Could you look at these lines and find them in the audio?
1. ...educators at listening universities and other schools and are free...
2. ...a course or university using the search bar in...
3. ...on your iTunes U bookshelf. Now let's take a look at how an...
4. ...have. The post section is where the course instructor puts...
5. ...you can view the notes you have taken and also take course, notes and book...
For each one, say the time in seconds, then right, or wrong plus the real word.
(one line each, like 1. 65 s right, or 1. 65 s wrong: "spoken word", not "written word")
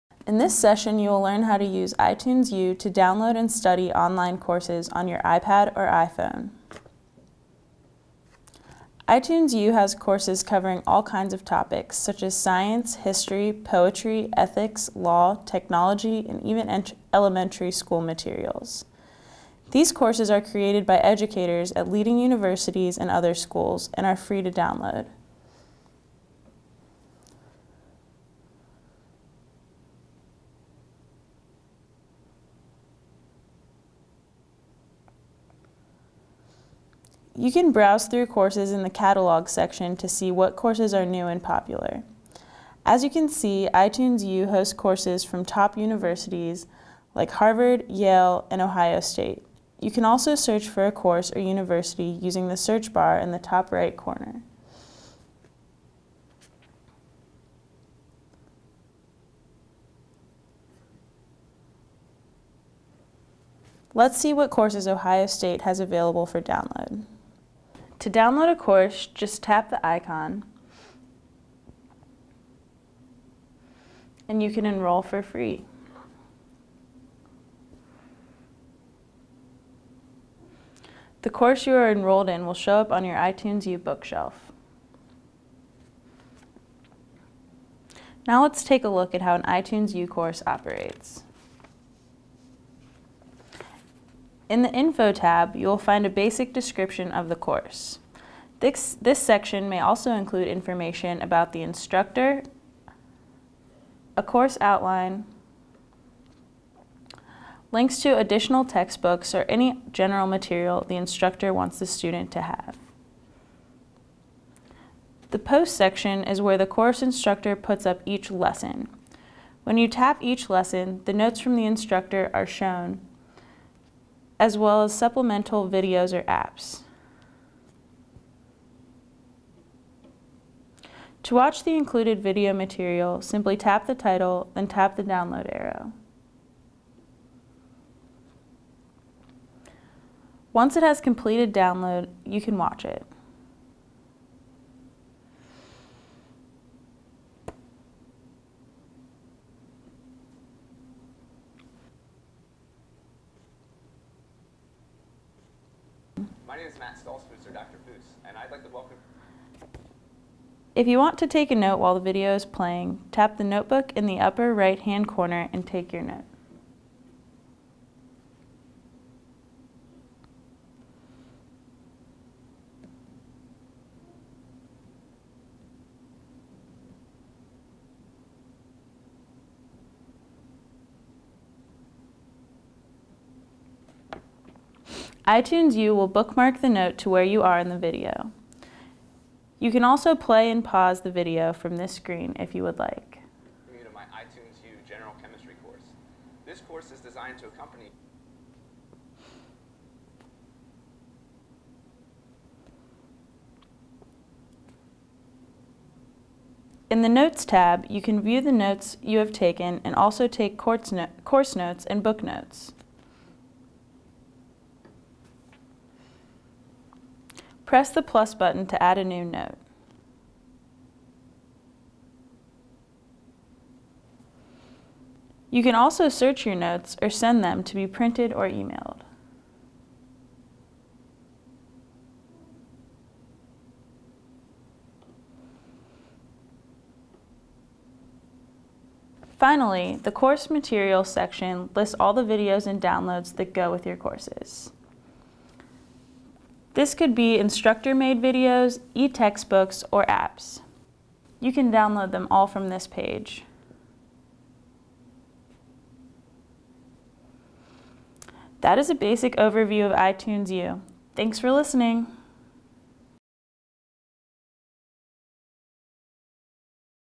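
1. 20 s wrong: "leading", not "listening"
2. 50 s right
3. 82 s right
4. 112 s right
5. 207 s right.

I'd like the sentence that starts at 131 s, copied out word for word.
To watch the included video material, simply tap the title, then tap the download arrow.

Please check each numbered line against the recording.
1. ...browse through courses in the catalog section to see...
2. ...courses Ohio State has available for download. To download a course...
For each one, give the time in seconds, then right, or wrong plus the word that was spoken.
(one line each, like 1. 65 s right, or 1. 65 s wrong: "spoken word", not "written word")
1. 37 s right
2. 64 s right.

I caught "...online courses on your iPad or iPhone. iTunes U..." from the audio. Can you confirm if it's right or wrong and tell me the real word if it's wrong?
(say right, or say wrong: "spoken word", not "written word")
right.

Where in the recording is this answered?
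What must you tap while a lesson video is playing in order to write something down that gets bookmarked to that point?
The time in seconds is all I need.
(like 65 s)
163 s.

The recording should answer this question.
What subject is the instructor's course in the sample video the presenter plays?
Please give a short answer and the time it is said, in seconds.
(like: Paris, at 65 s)
General Chemistry, at 194 s.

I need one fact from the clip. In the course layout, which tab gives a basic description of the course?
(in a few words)
Info.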